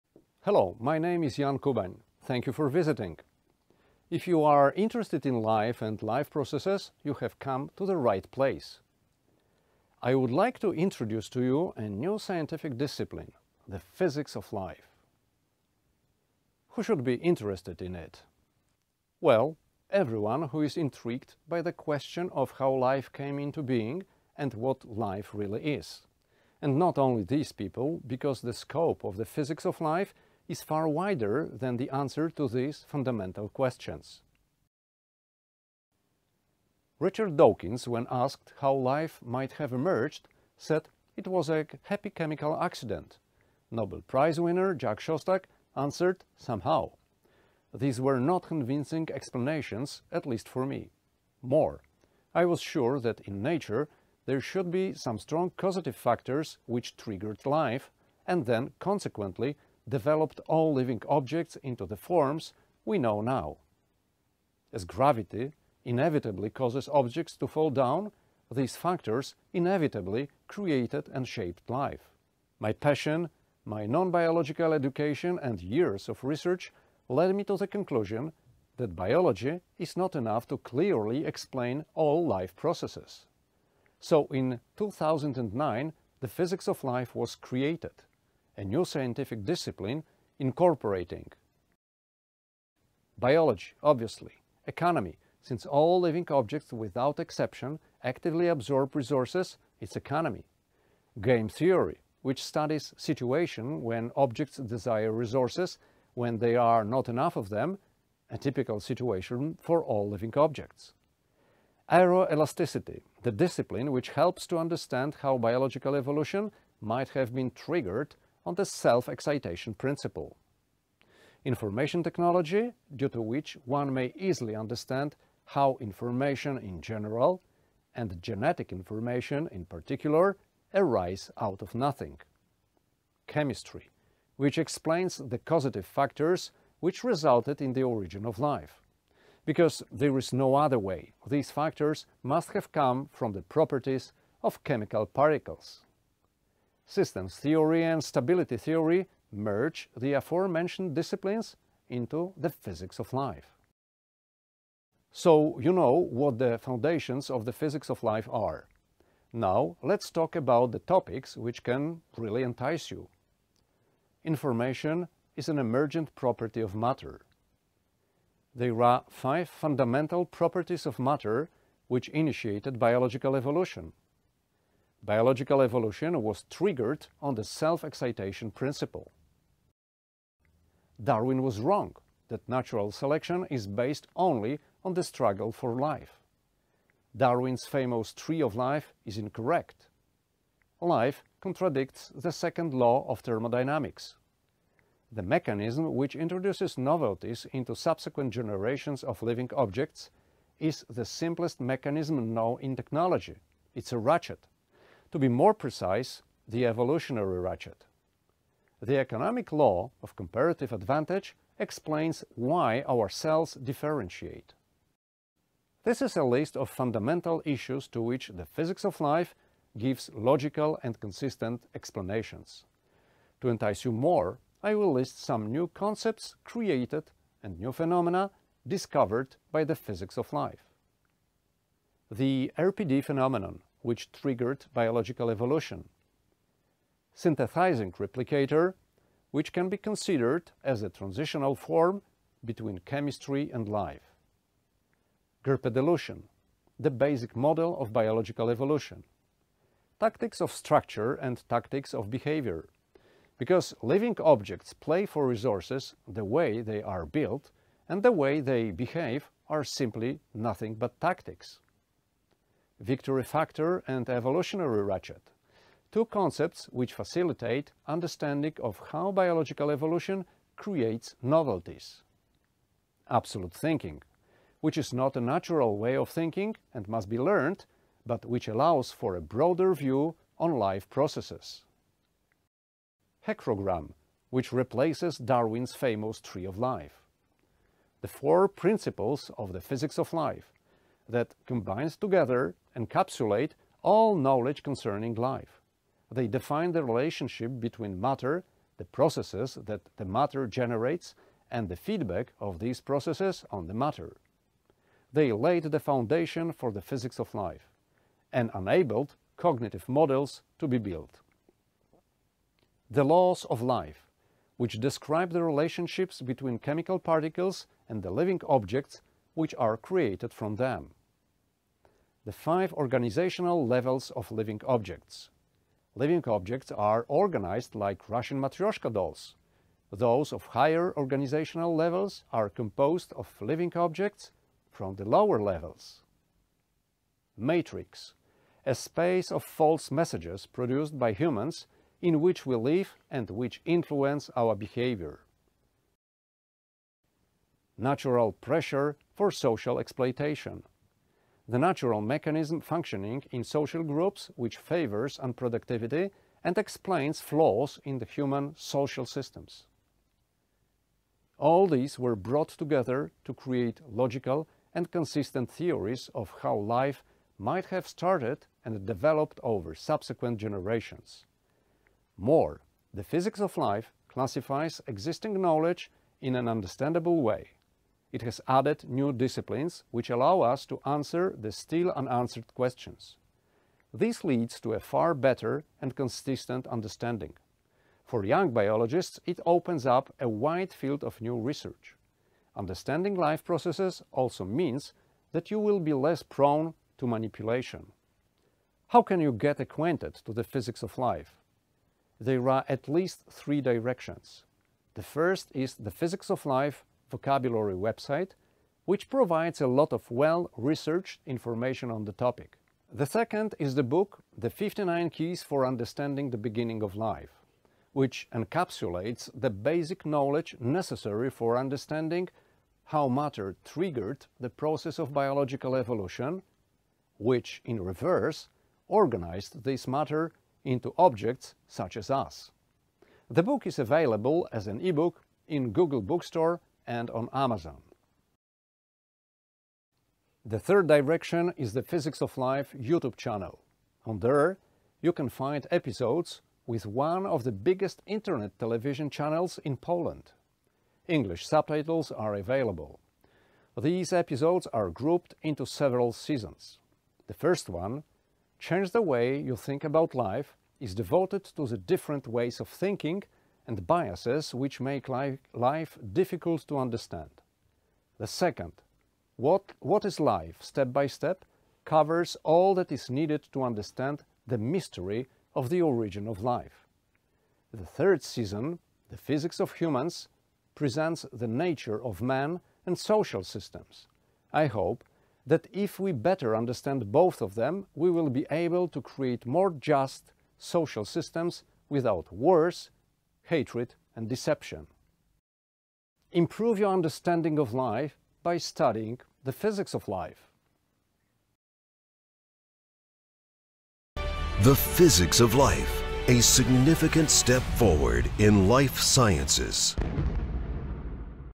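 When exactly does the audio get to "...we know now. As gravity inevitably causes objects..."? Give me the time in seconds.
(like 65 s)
62 s.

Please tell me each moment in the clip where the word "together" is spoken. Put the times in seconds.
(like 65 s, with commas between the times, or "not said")
291 s, 362 s.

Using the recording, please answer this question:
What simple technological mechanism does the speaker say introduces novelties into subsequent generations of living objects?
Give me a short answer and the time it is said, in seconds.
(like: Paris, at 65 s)
a ratchet, at 203 s.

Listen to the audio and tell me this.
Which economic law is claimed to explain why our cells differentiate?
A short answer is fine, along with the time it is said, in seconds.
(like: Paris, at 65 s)
law of comparative advantage, at 209 s.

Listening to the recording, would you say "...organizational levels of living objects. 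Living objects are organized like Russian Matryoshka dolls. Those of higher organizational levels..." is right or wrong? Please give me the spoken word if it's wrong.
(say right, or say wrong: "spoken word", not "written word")
right.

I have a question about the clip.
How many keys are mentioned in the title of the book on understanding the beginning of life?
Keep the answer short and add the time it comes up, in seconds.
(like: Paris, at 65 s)
59, at 414 s.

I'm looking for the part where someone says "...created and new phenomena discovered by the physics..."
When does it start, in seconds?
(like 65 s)
226 s.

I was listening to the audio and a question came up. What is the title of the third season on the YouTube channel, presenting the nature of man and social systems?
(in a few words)
The Physics of Humans.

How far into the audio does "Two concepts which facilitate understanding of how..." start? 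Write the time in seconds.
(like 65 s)
265 s.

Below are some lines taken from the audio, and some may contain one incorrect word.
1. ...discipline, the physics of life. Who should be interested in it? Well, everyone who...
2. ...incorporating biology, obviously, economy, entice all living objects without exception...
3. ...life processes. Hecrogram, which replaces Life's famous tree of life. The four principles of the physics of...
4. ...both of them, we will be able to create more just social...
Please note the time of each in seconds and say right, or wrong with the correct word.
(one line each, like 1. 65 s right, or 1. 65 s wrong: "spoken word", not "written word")
1. 12 s right
2. 90 s wrong: "since", not "entice"
3. 280 s wrong: "Darwin", not "Life"
4. 487 s right.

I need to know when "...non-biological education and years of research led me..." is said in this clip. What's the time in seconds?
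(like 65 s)
73 s.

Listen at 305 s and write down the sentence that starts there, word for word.
They laid the foundation for the physics of life and enabled cognitive models to be built.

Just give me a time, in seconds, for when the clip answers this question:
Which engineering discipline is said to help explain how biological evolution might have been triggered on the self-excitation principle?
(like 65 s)
111 s.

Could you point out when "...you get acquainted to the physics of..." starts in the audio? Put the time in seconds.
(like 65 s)
399 s.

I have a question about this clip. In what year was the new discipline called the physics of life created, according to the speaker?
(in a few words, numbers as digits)
2009.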